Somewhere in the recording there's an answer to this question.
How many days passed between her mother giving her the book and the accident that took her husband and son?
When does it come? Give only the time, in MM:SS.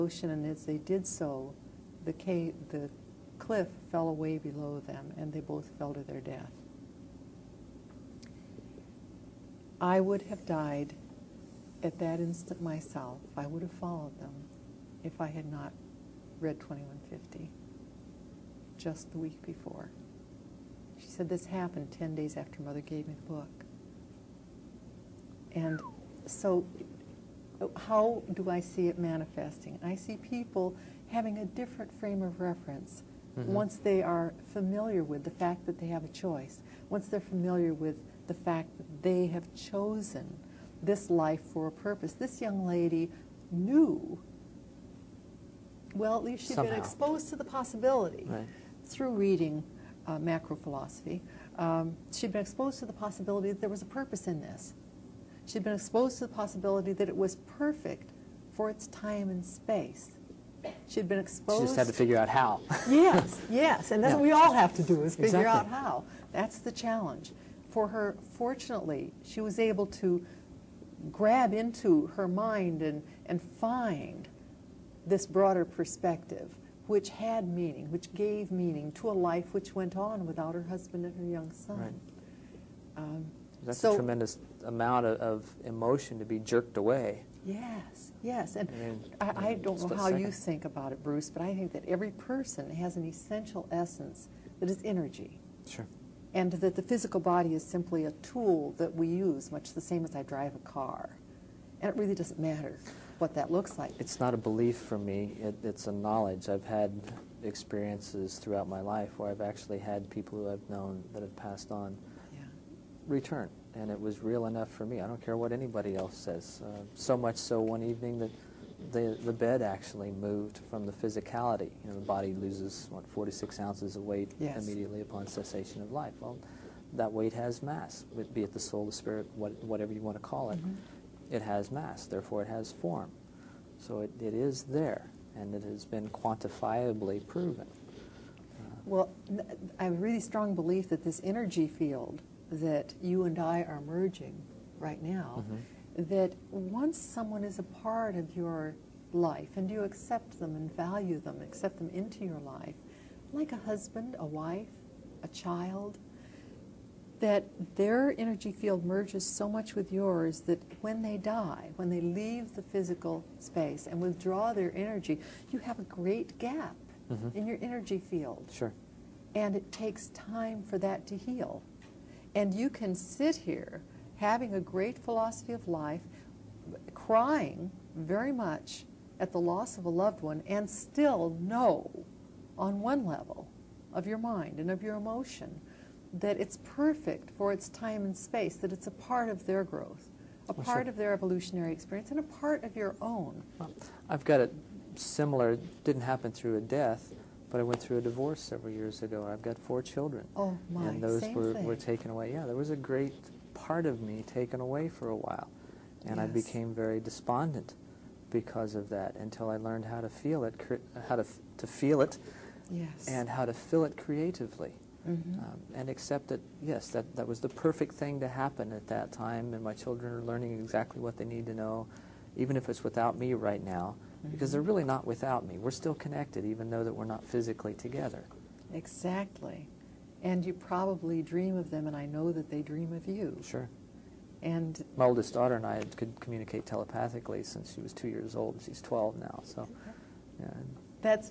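00:21.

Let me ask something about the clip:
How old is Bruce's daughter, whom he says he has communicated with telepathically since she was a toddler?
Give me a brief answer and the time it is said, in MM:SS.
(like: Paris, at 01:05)
12, at 03:58.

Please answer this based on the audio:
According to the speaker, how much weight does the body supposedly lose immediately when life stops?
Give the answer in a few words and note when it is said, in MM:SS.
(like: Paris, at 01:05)
46 ounces, at 02:03.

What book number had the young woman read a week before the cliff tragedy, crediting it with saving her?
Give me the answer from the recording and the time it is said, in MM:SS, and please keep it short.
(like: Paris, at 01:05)
2150, at 00:16.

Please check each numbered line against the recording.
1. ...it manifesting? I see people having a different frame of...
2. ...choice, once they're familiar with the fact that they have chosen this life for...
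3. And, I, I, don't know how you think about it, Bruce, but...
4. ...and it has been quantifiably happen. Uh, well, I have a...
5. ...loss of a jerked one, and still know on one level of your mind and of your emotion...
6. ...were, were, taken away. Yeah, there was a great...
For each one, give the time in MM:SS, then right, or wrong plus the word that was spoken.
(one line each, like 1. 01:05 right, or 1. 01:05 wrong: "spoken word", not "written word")
1. 00:28 right
2. 00:36 right
3. 01:28 right
4. 02:15 wrong: "proven", not "happen"
5. 02:59 wrong: "loved", not "jerked"
6. 03:21 right.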